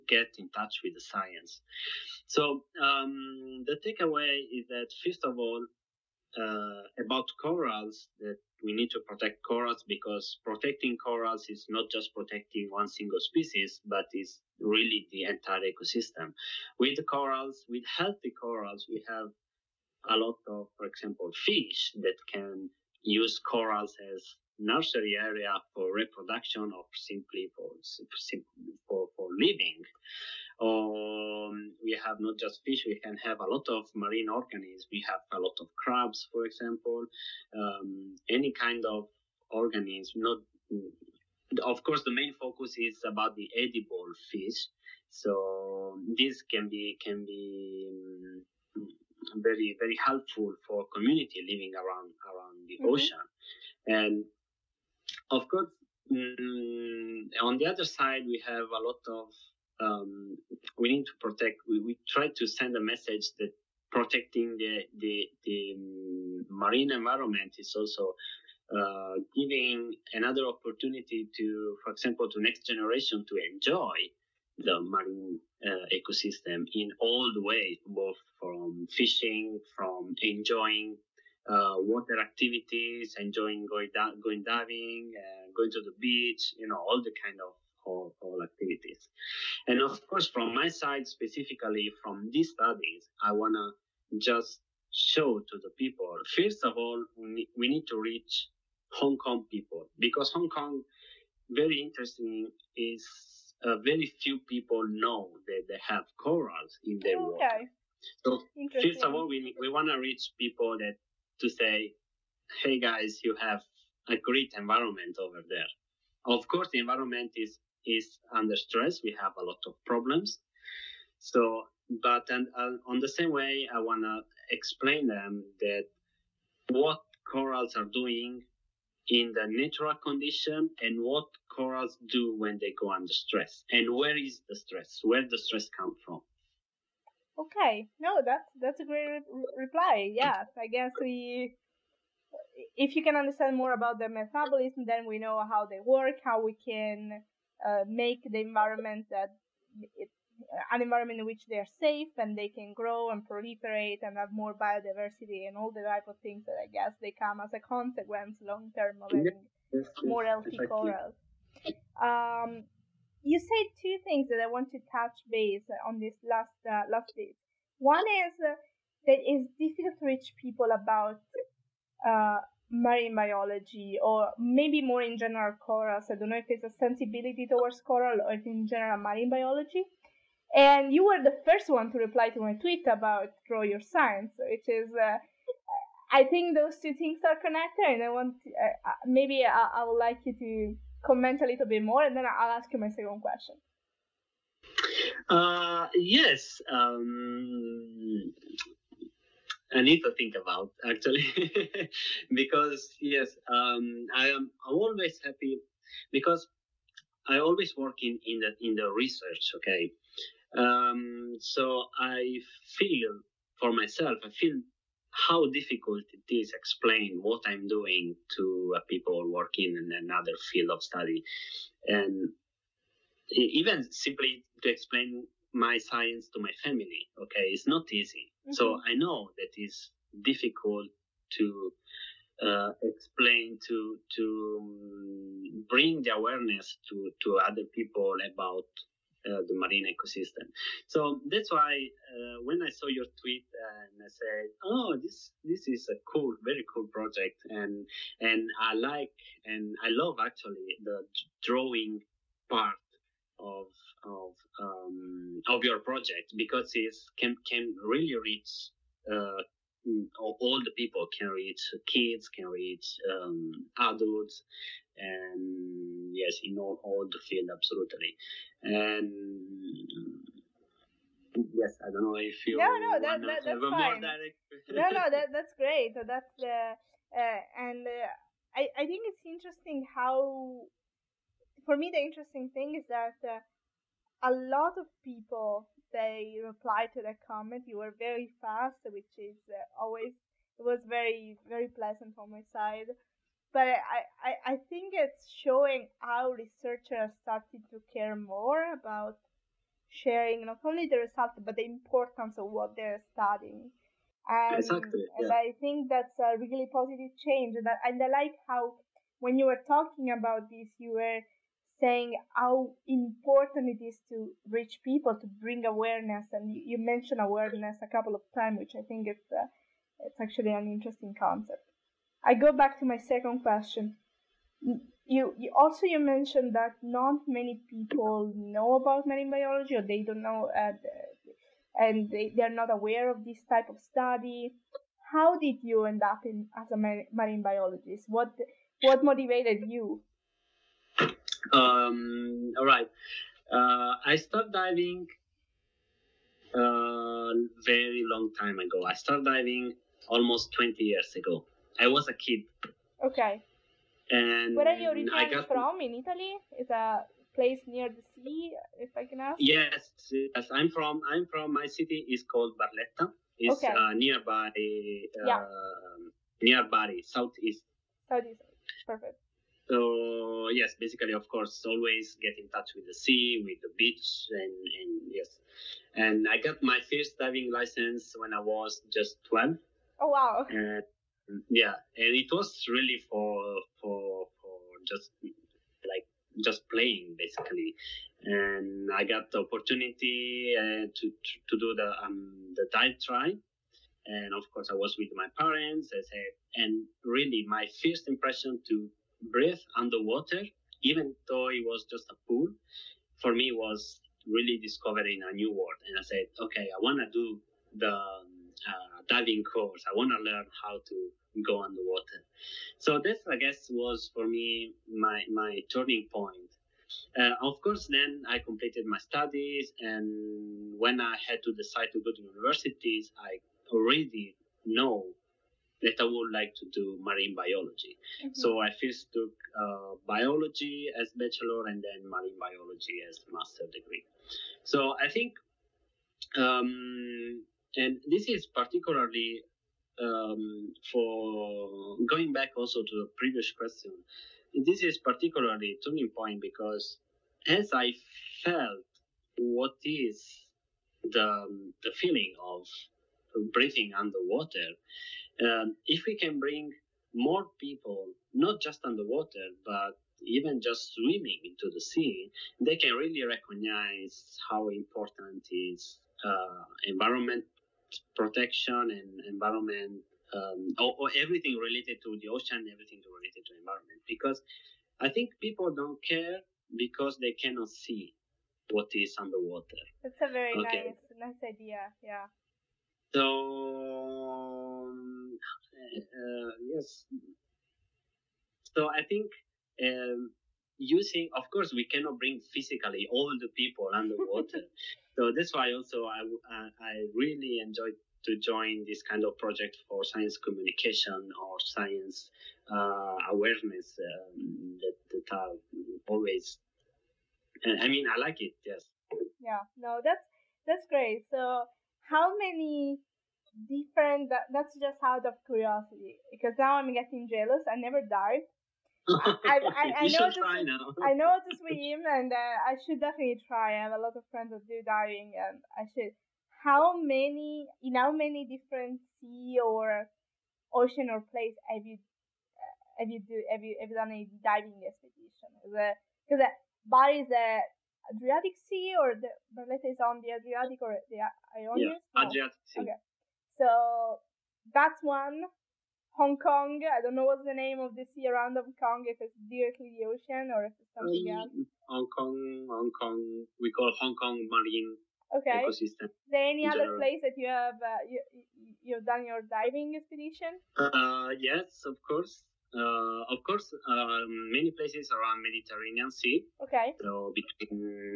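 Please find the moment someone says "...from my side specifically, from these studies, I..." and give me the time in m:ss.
1:30.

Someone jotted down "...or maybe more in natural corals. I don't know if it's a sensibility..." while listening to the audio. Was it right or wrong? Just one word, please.
wrong.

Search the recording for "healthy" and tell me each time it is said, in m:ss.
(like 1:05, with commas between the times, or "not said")
0:17, 2:40.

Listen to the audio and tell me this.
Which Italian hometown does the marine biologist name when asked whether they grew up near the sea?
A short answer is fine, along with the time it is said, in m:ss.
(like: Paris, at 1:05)
Barletta, at 6:02.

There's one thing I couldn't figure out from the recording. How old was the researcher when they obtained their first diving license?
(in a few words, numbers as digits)
12.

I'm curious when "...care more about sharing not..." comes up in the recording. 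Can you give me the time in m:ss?
4:57.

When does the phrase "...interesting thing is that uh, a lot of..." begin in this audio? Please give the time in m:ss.
4:41.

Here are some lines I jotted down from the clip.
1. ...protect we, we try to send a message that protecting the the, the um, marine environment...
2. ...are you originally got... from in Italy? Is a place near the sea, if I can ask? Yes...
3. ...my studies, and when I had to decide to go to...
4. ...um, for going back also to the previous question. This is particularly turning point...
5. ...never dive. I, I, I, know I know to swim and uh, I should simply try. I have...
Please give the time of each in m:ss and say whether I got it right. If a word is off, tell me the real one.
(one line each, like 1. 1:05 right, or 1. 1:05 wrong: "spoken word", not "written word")
1. 1:01 right
2. 5:54 right
3. 6:58 right
4. 7:20 right
5. 8:37 wrong: "definitely", not "simply".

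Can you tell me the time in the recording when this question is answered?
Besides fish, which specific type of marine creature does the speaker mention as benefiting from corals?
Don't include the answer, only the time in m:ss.
0:35.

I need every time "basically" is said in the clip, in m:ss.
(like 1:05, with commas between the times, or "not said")
6:10, 6:27.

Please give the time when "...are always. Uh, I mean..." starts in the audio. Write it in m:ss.
8:25.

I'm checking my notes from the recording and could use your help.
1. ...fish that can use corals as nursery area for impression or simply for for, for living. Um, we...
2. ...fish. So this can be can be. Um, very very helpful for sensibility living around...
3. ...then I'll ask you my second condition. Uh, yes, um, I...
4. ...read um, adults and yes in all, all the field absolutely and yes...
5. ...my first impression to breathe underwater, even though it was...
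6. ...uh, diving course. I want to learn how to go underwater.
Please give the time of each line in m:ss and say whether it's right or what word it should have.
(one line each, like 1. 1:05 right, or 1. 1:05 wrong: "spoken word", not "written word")
1. 0:21 wrong: "reproduction", not "impression"
2. 0:44 wrong: "community", not "sensibility"
3. 3:12 wrong: "question", not "condition"
4. 4:22 right
5. 6:37 right
6. 6:47 right.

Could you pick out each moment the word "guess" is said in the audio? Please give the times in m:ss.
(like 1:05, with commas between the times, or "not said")
2:20, 2:36, 6:53.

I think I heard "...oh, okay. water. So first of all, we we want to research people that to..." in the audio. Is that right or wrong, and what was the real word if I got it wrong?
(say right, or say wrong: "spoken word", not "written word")
wrong: "reach", not "research".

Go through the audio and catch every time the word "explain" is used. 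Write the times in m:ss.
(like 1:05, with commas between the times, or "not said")
2:04, 3:36, 3:44, 3:52.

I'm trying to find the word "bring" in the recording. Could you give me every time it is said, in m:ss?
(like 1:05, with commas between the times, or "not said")
3:55, 5:15, 7:36, 8:12.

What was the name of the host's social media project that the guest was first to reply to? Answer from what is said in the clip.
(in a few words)
draw your science.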